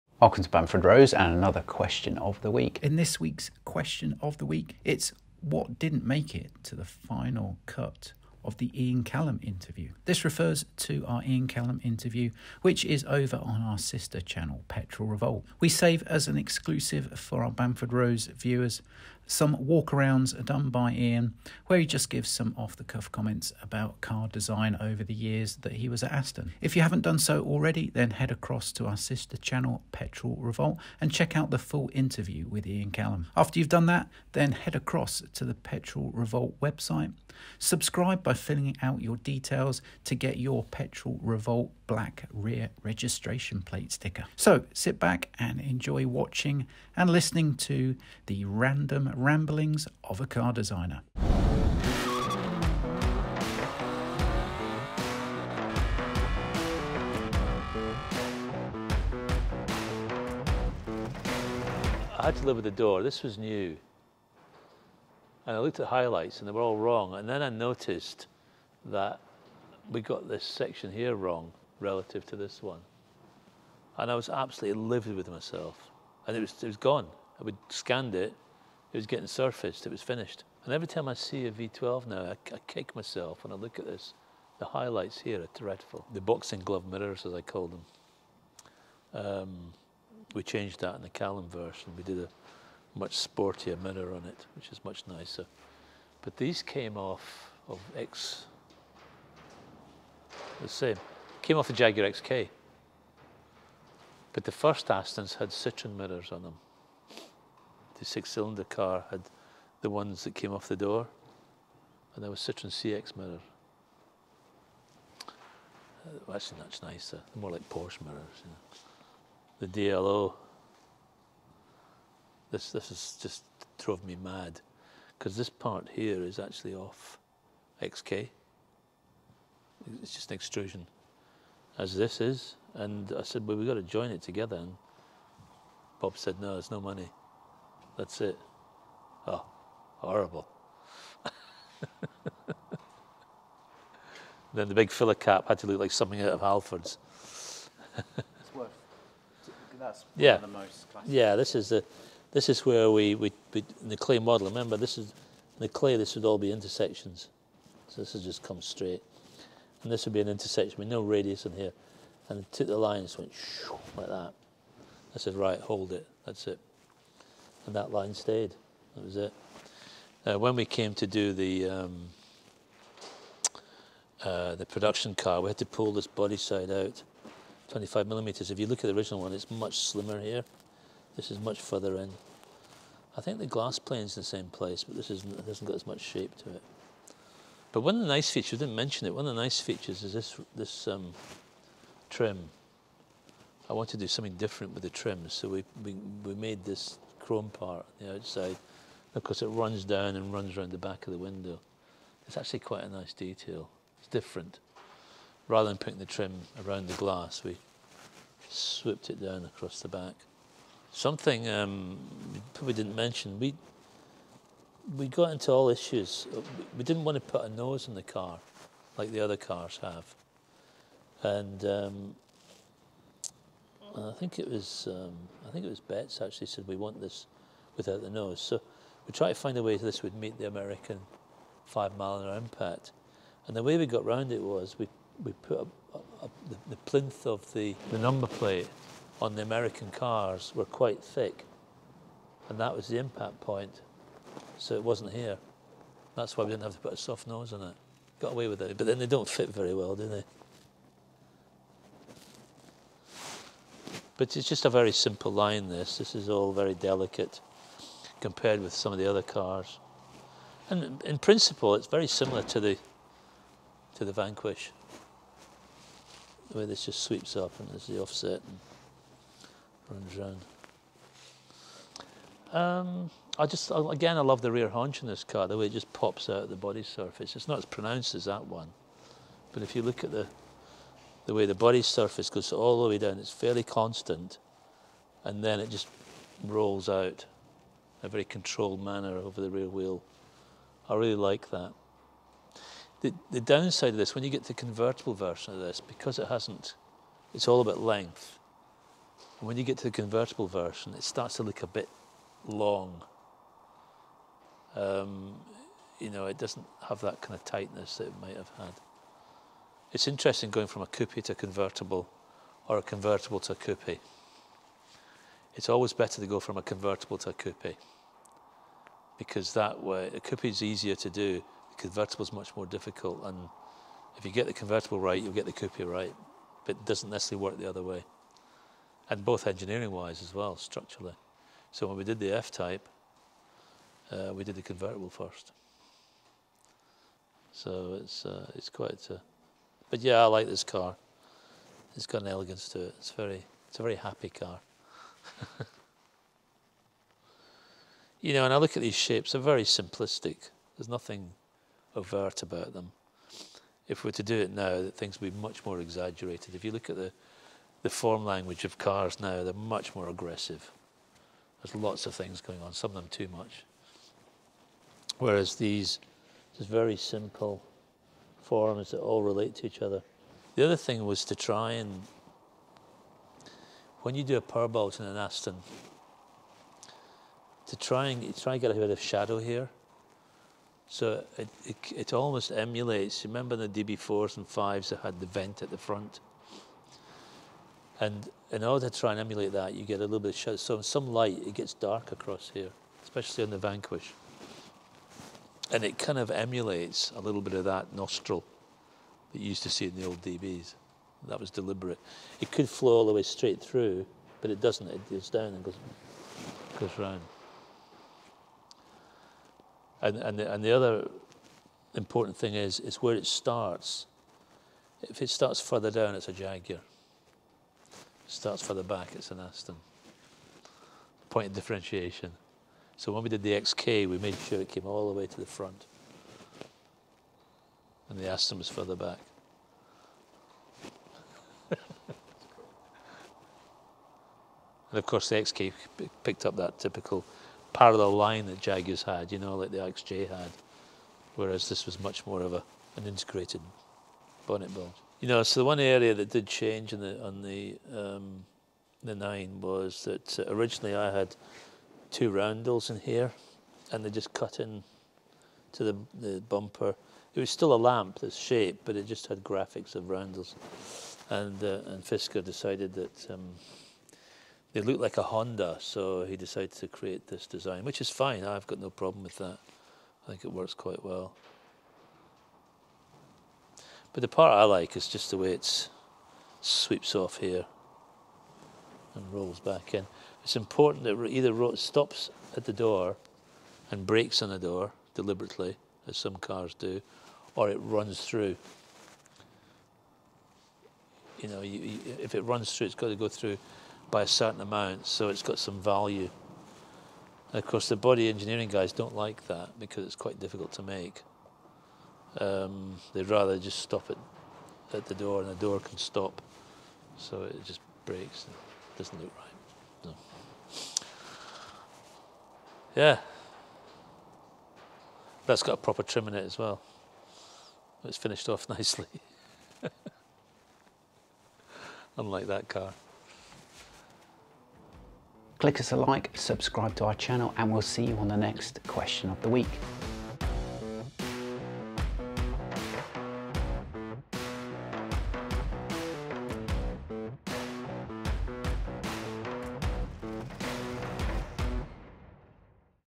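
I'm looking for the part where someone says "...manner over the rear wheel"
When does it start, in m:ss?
4:48.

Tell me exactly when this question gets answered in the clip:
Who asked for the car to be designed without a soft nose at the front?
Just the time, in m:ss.
3:45.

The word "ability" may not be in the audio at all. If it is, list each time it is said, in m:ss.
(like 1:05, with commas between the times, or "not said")
not said.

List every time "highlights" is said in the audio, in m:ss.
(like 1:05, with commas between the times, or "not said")
1:05, 1:24.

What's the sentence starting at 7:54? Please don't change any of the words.
But the part I like is just the way it sweeps off here and rolls back in.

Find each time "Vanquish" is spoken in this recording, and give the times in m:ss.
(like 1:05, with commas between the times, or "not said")
4:24, 6:33.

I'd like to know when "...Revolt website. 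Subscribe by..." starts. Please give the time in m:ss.
0:36.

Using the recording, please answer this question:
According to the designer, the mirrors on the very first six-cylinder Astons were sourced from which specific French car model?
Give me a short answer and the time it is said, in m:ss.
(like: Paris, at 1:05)
Citroen CX, at 1:52.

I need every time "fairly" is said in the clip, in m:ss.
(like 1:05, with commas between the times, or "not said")
4:43.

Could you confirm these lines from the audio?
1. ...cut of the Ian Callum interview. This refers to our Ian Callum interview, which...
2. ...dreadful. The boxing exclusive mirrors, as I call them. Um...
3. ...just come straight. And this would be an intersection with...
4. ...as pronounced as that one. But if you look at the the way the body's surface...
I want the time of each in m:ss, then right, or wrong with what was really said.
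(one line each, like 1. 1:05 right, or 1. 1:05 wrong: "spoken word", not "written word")
1. 0:07 right
2. 1:25 wrong: "glove", not "exclusive"
3. 2:38 right
4. 4:37 right.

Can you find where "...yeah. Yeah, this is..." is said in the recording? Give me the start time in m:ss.
2:30.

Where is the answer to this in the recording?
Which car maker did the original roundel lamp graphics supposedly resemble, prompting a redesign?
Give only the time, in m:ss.
7:45.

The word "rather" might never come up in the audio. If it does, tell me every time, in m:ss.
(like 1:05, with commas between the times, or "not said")
3:25, 8:23.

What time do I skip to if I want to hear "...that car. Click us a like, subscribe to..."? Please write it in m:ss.
8:42.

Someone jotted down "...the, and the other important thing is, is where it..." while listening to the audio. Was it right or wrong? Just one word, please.
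right.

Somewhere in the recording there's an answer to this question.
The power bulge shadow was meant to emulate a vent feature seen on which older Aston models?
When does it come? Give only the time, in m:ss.
6:23.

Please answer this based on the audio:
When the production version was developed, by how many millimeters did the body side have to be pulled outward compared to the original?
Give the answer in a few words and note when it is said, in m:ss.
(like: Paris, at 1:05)
25 millimeters, at 2:57.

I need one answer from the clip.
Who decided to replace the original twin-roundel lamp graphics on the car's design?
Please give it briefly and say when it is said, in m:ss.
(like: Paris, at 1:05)
Fisker, at 7:42.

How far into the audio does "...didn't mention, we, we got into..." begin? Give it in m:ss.
3:32.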